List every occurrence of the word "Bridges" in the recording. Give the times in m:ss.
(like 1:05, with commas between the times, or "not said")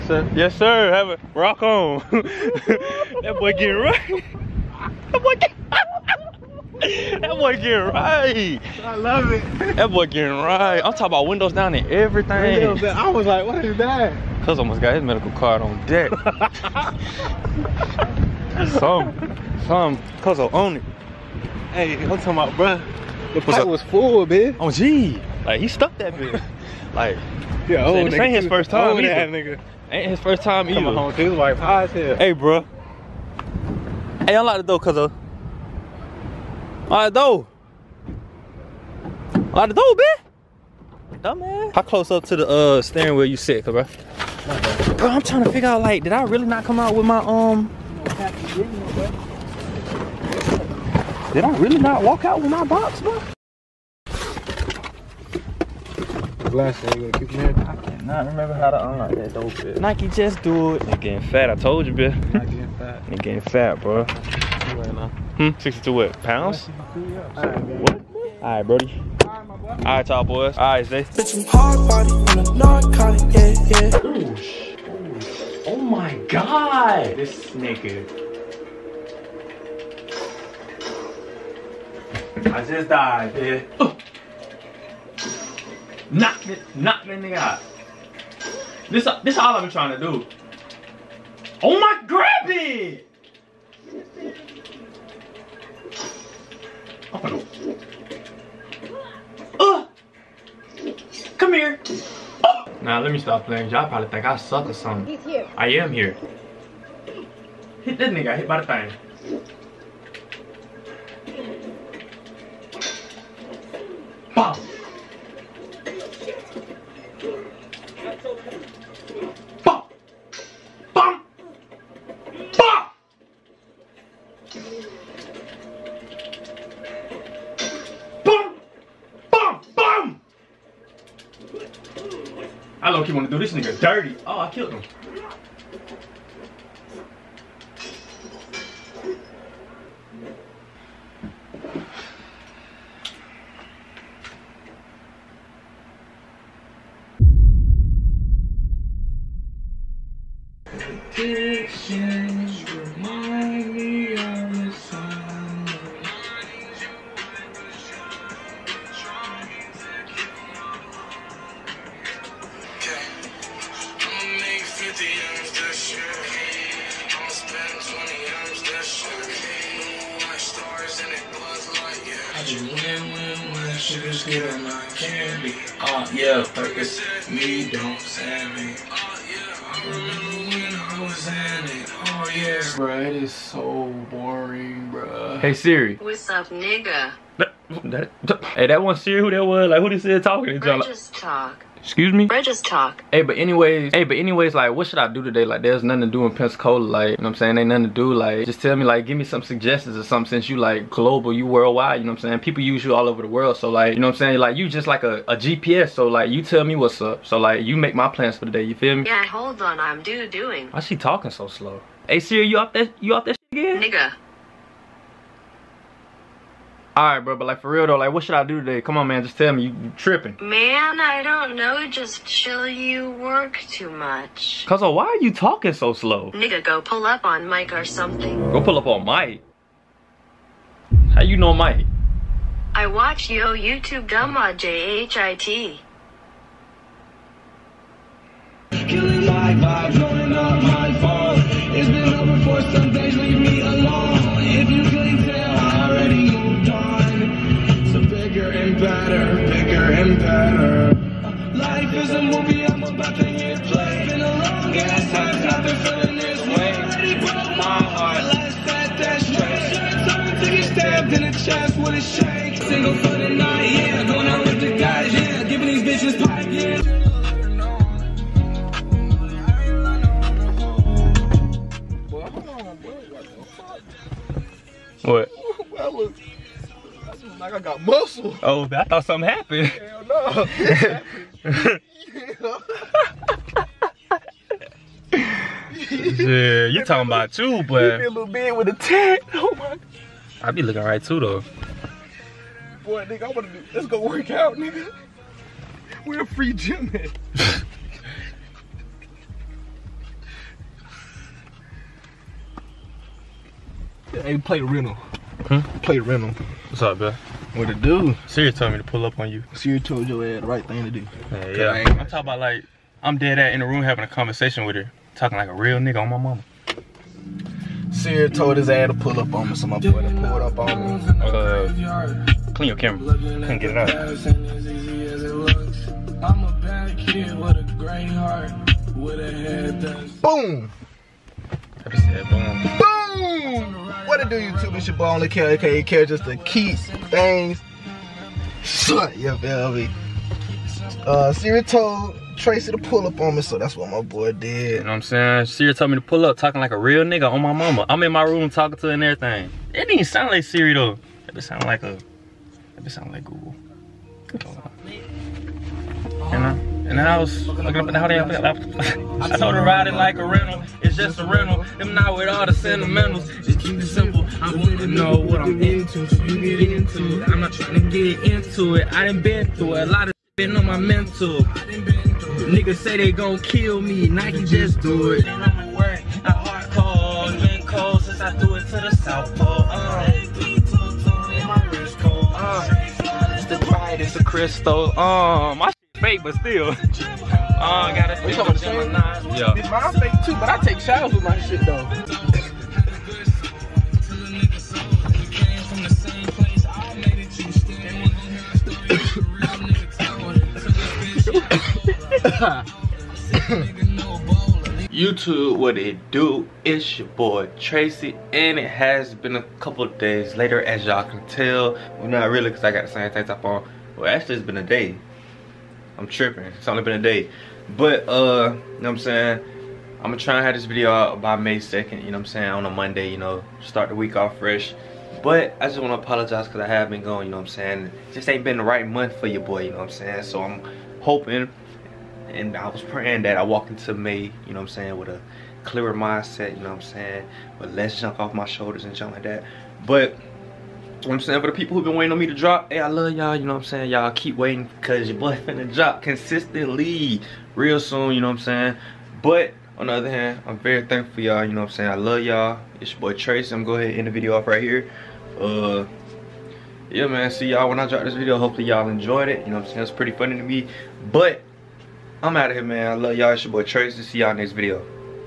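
3:12.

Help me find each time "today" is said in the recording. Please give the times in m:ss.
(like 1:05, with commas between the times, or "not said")
3:15, 3:38.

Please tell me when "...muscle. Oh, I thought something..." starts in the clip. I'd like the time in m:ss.
4:37.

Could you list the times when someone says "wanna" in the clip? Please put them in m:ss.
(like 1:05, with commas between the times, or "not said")
4:53, 7:05.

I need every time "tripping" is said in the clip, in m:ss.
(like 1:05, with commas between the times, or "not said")
3:39, 6:56.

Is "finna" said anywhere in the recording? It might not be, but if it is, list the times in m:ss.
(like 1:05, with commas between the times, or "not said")
7:25.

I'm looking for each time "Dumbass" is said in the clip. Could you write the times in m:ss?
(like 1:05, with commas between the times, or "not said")
0:41.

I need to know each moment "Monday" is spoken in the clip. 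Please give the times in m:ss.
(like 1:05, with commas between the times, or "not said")
7:02.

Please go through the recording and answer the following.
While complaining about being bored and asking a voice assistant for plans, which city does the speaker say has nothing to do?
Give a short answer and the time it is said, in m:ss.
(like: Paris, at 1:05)
Pensacola, at 3:16.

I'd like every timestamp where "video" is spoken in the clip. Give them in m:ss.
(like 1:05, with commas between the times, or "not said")
7:00, 7:34, 7:38, 7:44.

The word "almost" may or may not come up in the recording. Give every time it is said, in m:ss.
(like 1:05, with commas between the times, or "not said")
0:14.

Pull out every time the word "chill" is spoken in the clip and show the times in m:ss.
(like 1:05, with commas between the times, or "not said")
3:42.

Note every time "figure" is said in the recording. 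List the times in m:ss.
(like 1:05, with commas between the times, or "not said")
0:45.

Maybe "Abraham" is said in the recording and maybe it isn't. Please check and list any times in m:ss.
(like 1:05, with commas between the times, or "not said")
not said.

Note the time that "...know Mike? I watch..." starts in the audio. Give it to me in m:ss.
3:51.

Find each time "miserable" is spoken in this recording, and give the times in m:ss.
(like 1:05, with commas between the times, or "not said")
not said.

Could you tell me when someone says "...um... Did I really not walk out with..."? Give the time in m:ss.
0:47.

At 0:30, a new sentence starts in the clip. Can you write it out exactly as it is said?
Coming home to his wife high as hell.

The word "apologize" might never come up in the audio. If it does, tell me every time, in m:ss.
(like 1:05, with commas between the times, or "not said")
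7:05.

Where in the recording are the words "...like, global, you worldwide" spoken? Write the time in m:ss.
3:20.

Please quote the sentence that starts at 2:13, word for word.
you want to do this nigga dirty.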